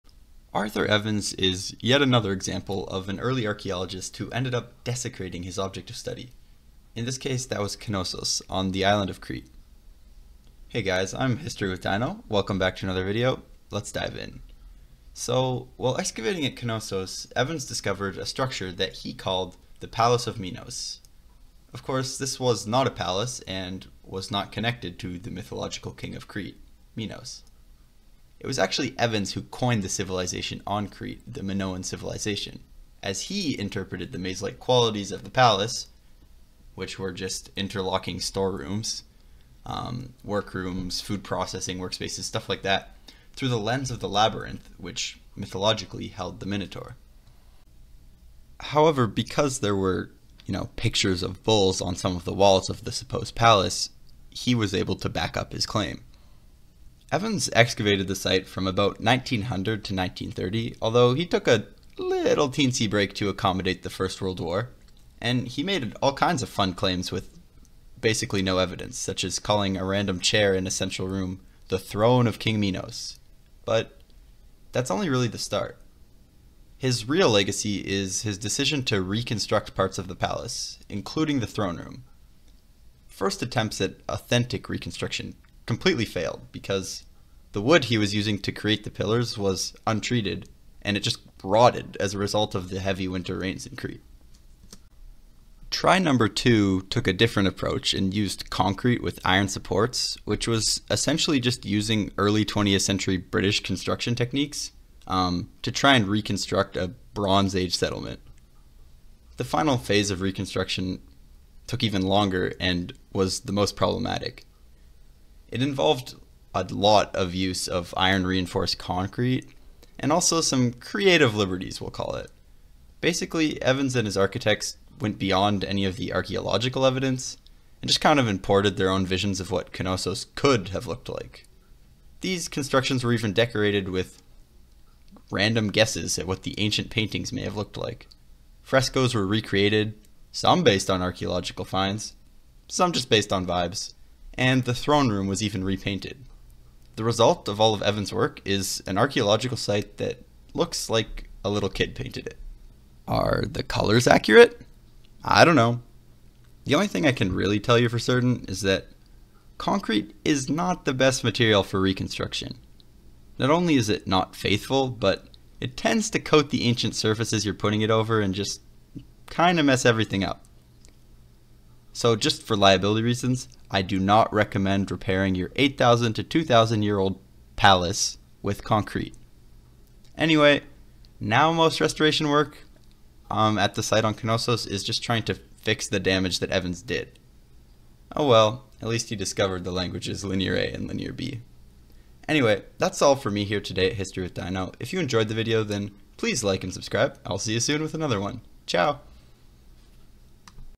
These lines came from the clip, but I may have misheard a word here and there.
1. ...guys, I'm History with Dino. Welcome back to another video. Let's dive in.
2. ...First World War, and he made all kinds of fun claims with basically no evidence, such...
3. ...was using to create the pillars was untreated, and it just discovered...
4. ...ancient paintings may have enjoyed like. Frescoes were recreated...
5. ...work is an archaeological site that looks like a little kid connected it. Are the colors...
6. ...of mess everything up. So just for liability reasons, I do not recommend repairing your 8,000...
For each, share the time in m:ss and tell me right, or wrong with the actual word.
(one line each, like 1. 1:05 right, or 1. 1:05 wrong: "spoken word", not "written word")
1. 0:10 right
2. 1:03 right
3. 1:27 wrong: "rotted", not "discovered"
4. 2:16 wrong: "looked", not "enjoyed"
5. 2:28 wrong: "painted", not "connected"
6. 2:49 right.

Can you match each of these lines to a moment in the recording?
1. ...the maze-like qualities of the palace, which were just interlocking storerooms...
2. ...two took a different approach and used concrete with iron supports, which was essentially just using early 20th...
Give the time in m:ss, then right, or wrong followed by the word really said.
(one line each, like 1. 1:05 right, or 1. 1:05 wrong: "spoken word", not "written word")
1. 0:34 right
2. 1:36 right.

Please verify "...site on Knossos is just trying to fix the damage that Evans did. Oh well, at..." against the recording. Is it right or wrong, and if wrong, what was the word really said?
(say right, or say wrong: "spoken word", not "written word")
right.